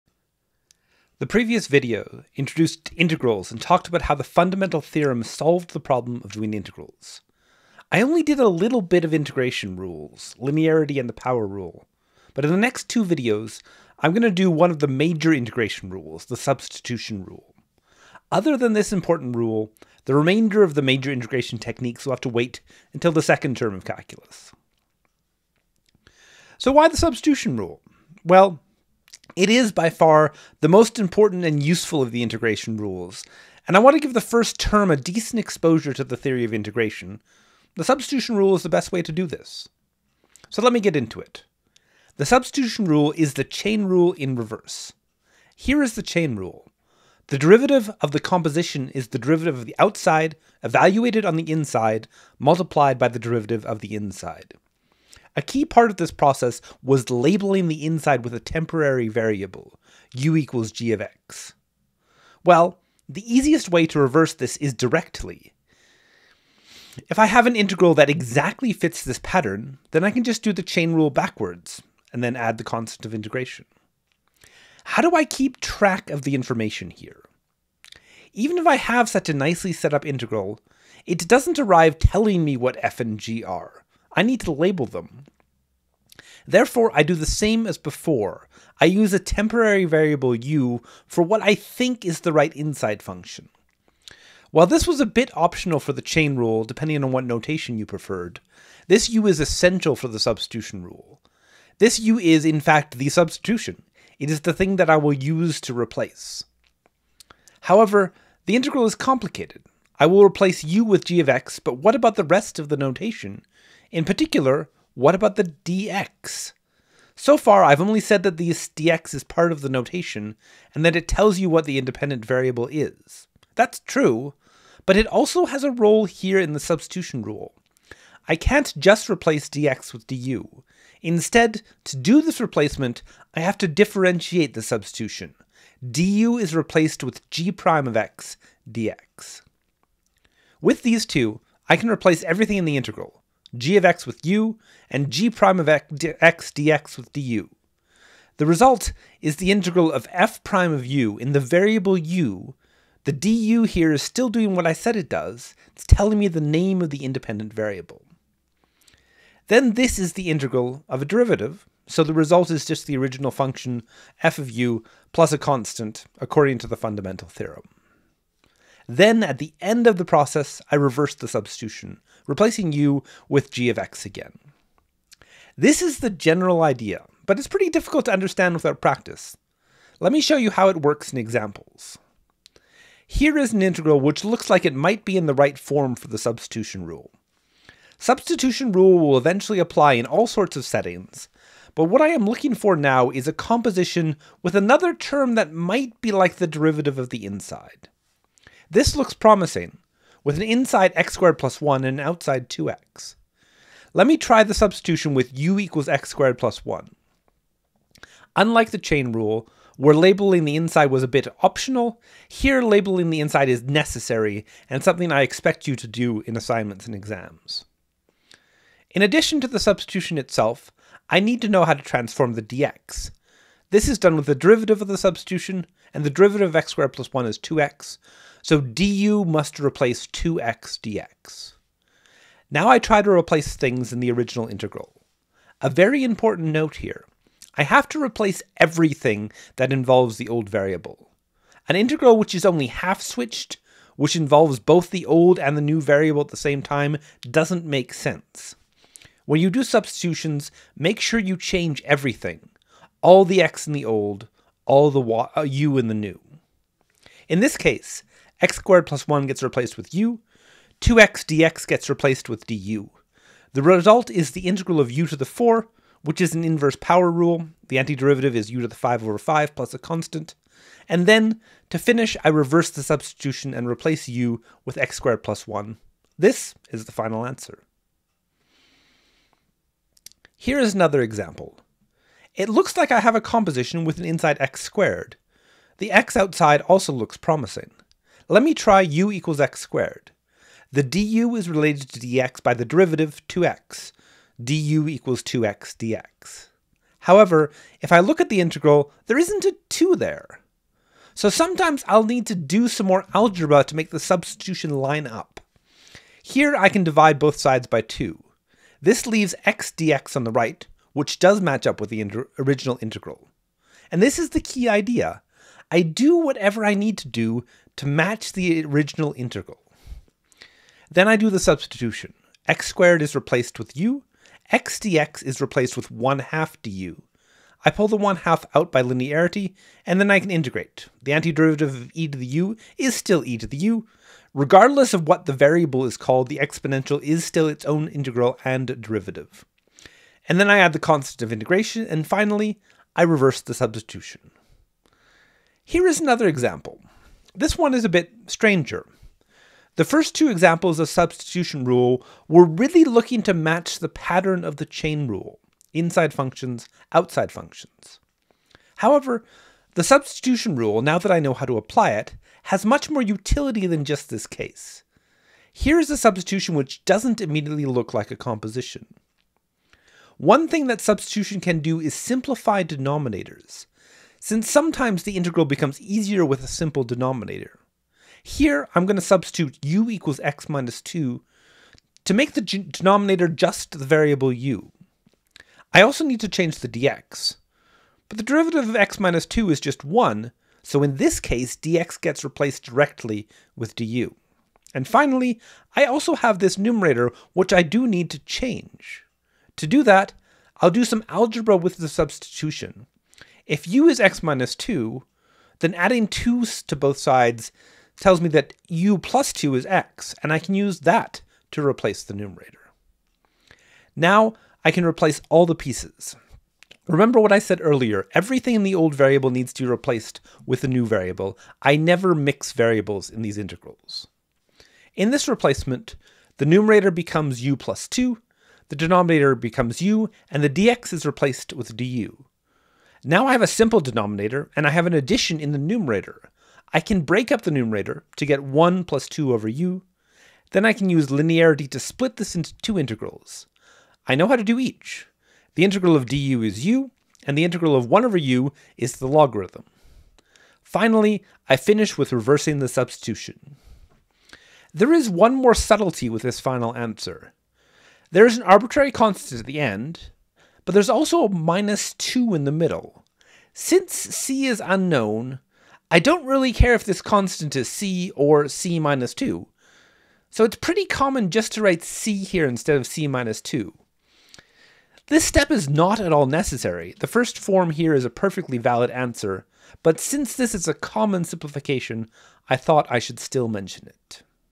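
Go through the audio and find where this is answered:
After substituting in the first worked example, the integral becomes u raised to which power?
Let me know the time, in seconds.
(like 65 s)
264 s.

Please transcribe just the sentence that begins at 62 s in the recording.
Well, the easiest way to reverse this is directly.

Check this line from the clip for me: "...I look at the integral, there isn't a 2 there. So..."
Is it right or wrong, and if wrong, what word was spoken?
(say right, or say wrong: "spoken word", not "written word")
right.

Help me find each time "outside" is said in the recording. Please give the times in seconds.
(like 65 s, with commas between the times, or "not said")
49 s, 202 s, 286 s, 356 s.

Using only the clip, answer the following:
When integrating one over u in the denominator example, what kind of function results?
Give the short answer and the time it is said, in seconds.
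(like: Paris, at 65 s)
The logarithm, at 448 s.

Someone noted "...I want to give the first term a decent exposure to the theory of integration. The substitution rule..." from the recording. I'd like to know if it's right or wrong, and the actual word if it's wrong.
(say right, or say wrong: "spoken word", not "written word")
right.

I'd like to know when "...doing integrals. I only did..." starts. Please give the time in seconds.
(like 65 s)
6 s.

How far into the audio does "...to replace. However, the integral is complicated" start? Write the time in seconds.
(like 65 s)
105 s.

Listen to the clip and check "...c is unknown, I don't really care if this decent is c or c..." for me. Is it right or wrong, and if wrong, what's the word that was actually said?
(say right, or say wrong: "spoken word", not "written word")
wrong: "constant", not "decent".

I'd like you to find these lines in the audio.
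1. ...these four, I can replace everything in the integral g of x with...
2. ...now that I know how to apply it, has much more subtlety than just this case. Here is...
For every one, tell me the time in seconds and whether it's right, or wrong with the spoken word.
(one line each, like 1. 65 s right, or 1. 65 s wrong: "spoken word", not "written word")
1. 140 s wrong: "two", not "four"
2. 360 s wrong: "utility", not "subtlety".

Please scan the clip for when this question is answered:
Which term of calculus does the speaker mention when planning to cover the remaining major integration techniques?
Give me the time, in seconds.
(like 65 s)
23 s.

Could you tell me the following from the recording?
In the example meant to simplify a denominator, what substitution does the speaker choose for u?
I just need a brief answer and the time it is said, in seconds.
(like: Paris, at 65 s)
x minus 2, at 379 s.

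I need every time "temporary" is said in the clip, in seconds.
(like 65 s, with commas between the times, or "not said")
58 s, 89 s.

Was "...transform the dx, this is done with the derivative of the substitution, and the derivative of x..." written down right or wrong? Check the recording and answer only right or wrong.
right.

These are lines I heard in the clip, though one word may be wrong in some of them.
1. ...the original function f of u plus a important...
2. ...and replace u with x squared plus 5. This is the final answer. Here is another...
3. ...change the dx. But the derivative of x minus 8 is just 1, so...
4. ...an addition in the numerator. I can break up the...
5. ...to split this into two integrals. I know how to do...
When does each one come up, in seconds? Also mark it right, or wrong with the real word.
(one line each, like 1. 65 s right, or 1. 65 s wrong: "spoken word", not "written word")
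1. 162 s wrong: "constant", not "important"
2. 273 s wrong: "1", not "5"
3. 386 s wrong: "2", not "8"
4. 434 s right
5. 441 s right.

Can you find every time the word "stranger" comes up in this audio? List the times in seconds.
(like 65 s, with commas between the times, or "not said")
348 s.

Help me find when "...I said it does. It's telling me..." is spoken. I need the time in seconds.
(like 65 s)
154 s.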